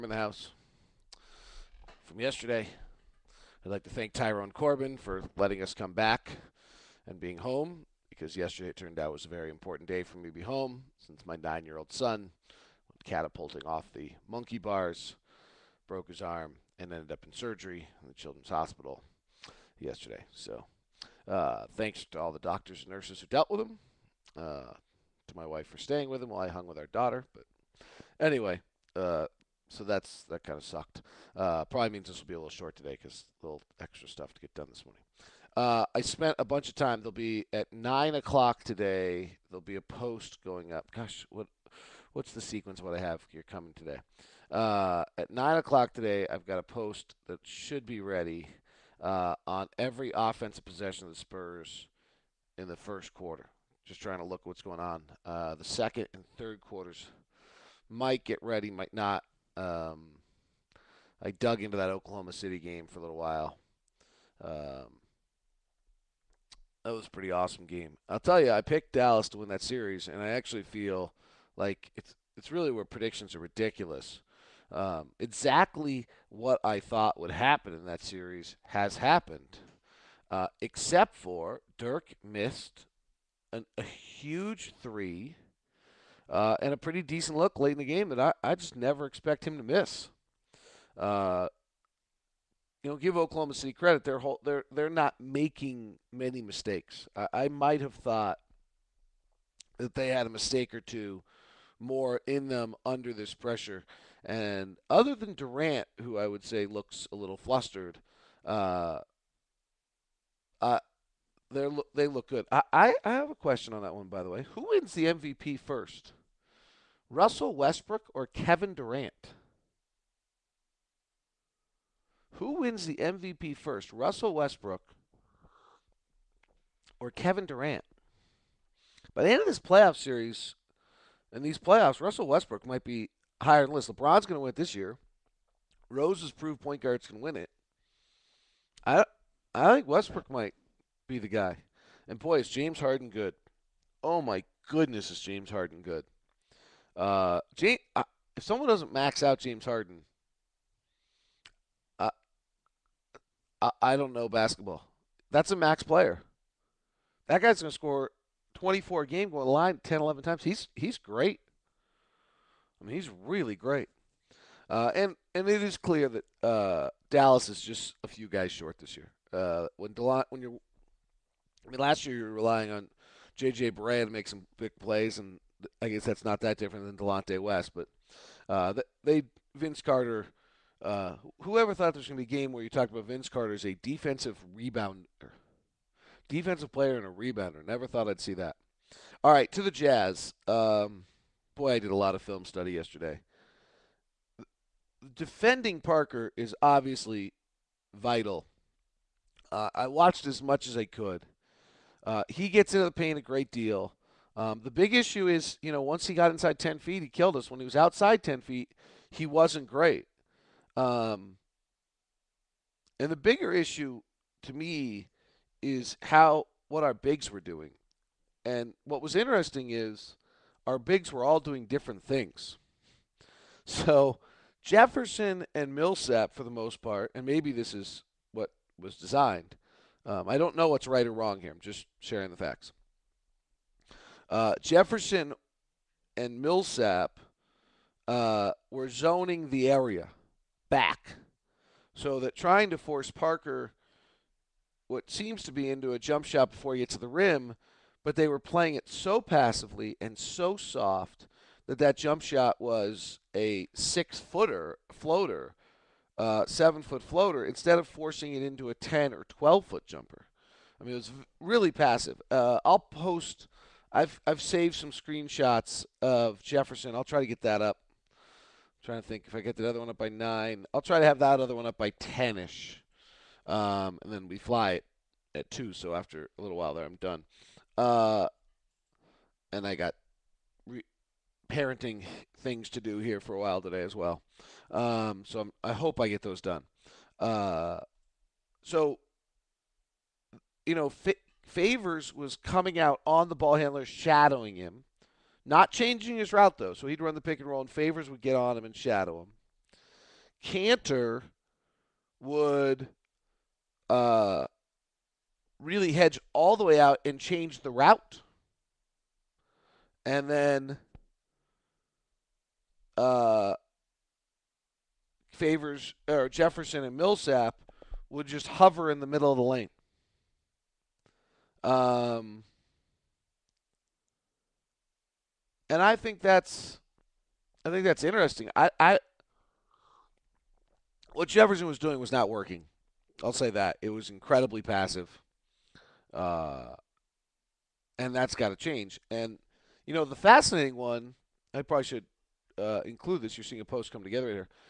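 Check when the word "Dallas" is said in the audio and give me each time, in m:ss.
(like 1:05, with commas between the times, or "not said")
1:08, 2:47.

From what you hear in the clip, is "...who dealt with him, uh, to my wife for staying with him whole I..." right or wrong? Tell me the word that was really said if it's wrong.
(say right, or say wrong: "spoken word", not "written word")
wrong: "while", not "whole".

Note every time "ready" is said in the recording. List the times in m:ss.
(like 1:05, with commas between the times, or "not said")
0:47, 0:58.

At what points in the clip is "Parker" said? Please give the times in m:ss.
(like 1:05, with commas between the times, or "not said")
3:15, 4:03.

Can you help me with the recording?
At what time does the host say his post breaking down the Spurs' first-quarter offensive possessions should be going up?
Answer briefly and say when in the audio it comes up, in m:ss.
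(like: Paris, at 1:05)
9 o'clock, at 0:45.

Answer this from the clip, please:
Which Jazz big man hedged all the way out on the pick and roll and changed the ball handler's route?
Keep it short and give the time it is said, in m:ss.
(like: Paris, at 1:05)
Kanter, at 5:00.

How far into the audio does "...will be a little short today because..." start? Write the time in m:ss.
0:32.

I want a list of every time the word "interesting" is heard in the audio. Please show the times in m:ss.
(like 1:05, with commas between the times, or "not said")
3:39, 5:28.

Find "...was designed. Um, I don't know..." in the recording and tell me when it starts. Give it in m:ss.
3:48.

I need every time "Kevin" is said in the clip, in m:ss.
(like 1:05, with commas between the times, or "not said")
1:58, 2:07.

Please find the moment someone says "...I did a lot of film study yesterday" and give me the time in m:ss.
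3:11.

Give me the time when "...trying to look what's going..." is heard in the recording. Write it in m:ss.
0:54.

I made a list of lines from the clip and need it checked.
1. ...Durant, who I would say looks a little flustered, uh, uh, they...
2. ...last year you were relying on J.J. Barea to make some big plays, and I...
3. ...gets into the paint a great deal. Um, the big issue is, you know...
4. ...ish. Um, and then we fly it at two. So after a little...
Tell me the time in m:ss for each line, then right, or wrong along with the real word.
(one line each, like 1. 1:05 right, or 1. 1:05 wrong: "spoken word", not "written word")
1. 1:45 right
2. 2:51 right
3. 3:22 right
4. 4:32 right.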